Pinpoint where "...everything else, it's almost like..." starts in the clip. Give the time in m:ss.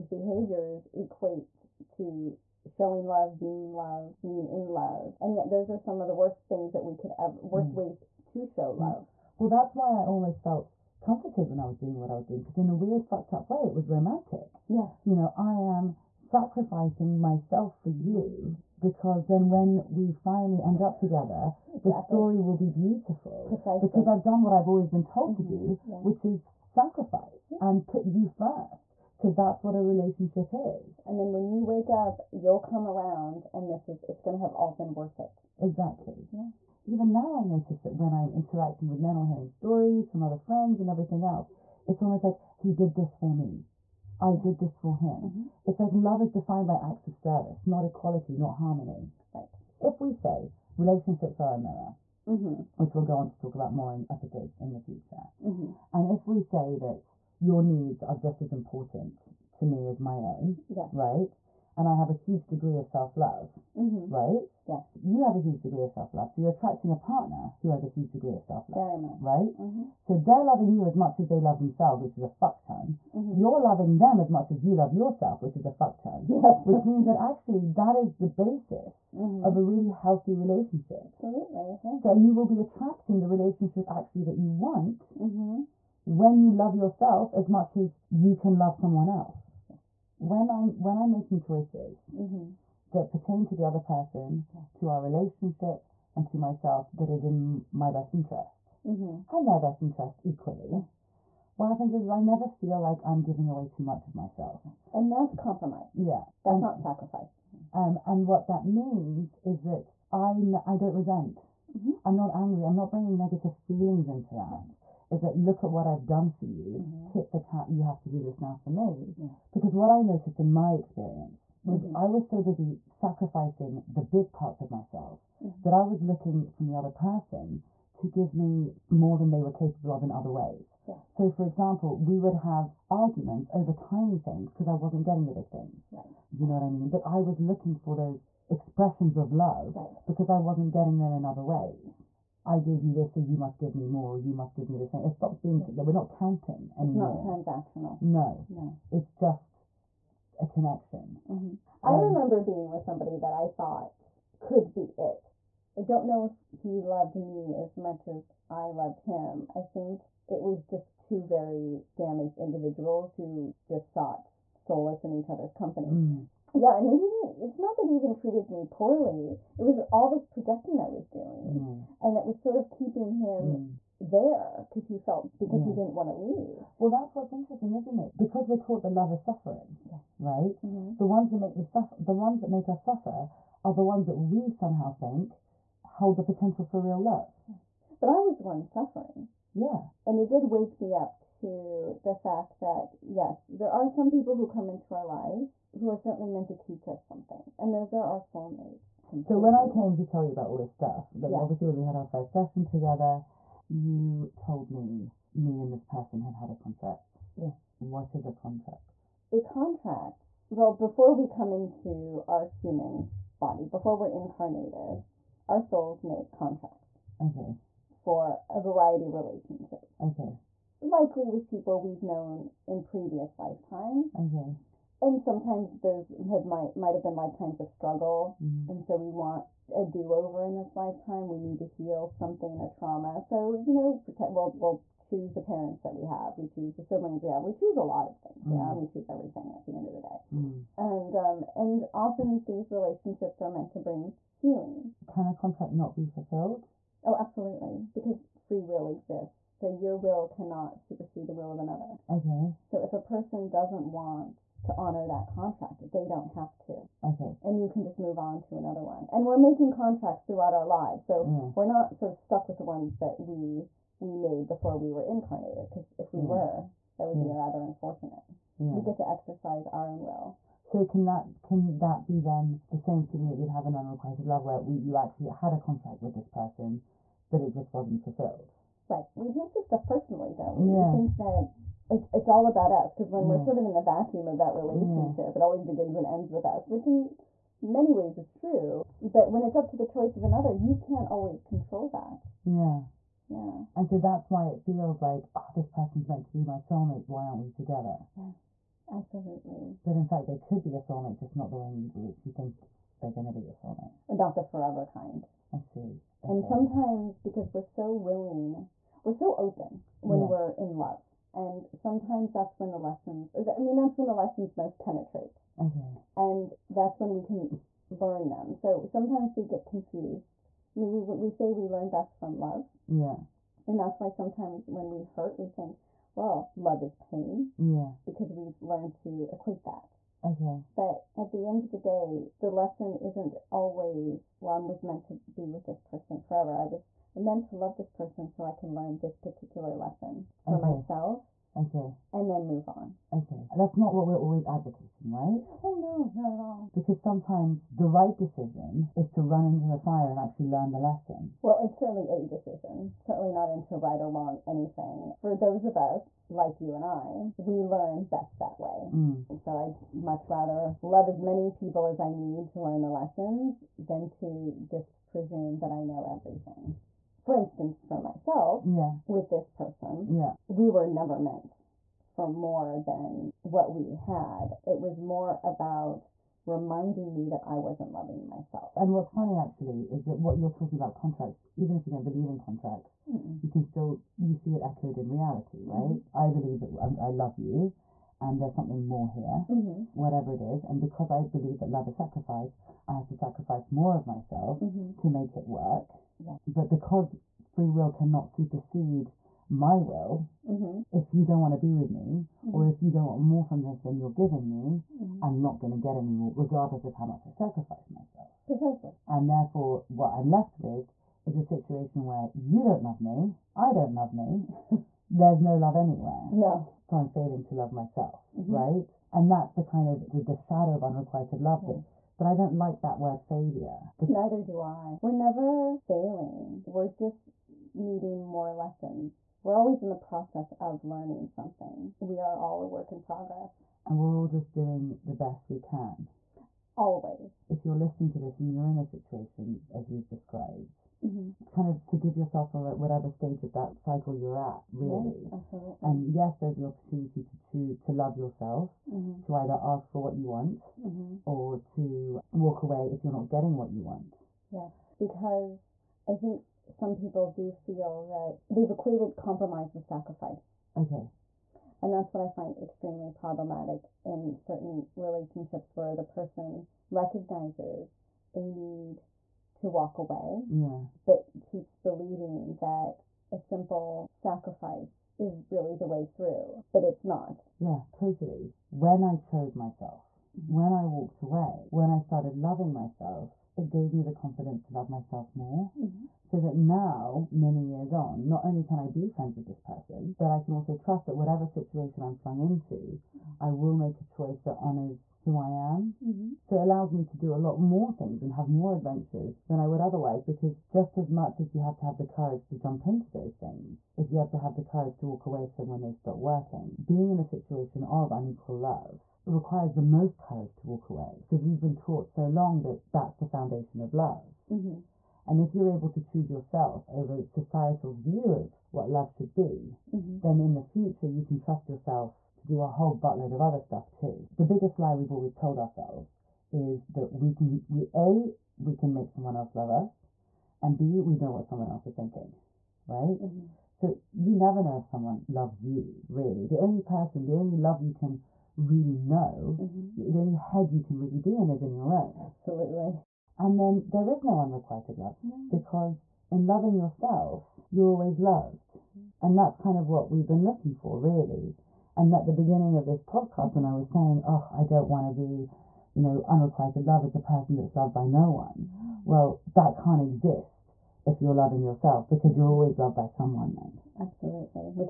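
0:40.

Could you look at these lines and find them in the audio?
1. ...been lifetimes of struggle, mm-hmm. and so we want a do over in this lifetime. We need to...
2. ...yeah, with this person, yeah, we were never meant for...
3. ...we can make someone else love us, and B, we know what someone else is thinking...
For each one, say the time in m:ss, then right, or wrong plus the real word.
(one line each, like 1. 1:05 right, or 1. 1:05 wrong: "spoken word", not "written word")
1. 3:47 right
2. 6:08 right
3. 8:48 right.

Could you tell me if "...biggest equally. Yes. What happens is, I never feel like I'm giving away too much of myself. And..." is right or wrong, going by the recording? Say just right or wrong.
wrong.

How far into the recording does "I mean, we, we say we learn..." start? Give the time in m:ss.
5:20.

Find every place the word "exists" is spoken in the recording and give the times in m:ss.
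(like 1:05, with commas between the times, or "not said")
4:08, 9:20.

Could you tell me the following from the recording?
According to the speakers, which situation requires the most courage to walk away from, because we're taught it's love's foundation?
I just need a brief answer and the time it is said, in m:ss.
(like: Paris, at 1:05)
unequal love, at 8:28.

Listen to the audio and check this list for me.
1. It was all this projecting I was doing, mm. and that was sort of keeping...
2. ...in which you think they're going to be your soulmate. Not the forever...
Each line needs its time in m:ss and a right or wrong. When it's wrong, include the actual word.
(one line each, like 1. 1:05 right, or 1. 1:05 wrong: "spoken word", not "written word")
1. 2:49 right
2. 5:01 right.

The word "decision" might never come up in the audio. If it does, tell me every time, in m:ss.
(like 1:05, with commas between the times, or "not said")
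5:48, 5:52.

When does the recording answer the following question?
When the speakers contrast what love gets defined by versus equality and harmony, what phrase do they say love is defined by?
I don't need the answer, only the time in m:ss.
0:46.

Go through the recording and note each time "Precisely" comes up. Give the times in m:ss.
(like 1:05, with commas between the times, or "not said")
0:23, 6:48.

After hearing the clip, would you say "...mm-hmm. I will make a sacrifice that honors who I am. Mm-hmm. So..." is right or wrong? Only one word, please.
wrong.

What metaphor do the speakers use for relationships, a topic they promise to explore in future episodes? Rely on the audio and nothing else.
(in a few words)
a mirror.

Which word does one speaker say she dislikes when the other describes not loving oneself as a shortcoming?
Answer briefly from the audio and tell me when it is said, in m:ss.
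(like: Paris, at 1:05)
failure, at 7:03.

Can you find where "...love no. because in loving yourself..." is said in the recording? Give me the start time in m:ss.
9:04.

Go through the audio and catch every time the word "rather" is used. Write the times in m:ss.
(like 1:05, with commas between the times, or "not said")
4:27, 6:00.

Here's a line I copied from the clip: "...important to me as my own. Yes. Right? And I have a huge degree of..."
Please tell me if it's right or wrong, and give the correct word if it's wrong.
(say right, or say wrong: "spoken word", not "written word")
right.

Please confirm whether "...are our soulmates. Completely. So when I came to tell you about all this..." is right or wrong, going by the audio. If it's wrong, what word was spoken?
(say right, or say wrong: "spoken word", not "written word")
right.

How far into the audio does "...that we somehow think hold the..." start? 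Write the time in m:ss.
3:04.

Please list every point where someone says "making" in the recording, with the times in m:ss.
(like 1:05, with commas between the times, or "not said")
1:31, 4:19.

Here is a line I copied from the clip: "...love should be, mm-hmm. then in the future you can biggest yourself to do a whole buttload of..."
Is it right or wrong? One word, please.
wrong.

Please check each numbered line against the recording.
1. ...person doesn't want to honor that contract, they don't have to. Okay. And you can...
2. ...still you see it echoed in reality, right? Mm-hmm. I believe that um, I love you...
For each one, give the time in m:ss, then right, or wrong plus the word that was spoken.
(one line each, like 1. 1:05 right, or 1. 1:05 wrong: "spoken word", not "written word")
1. 4:12 right
2. 6:23 right.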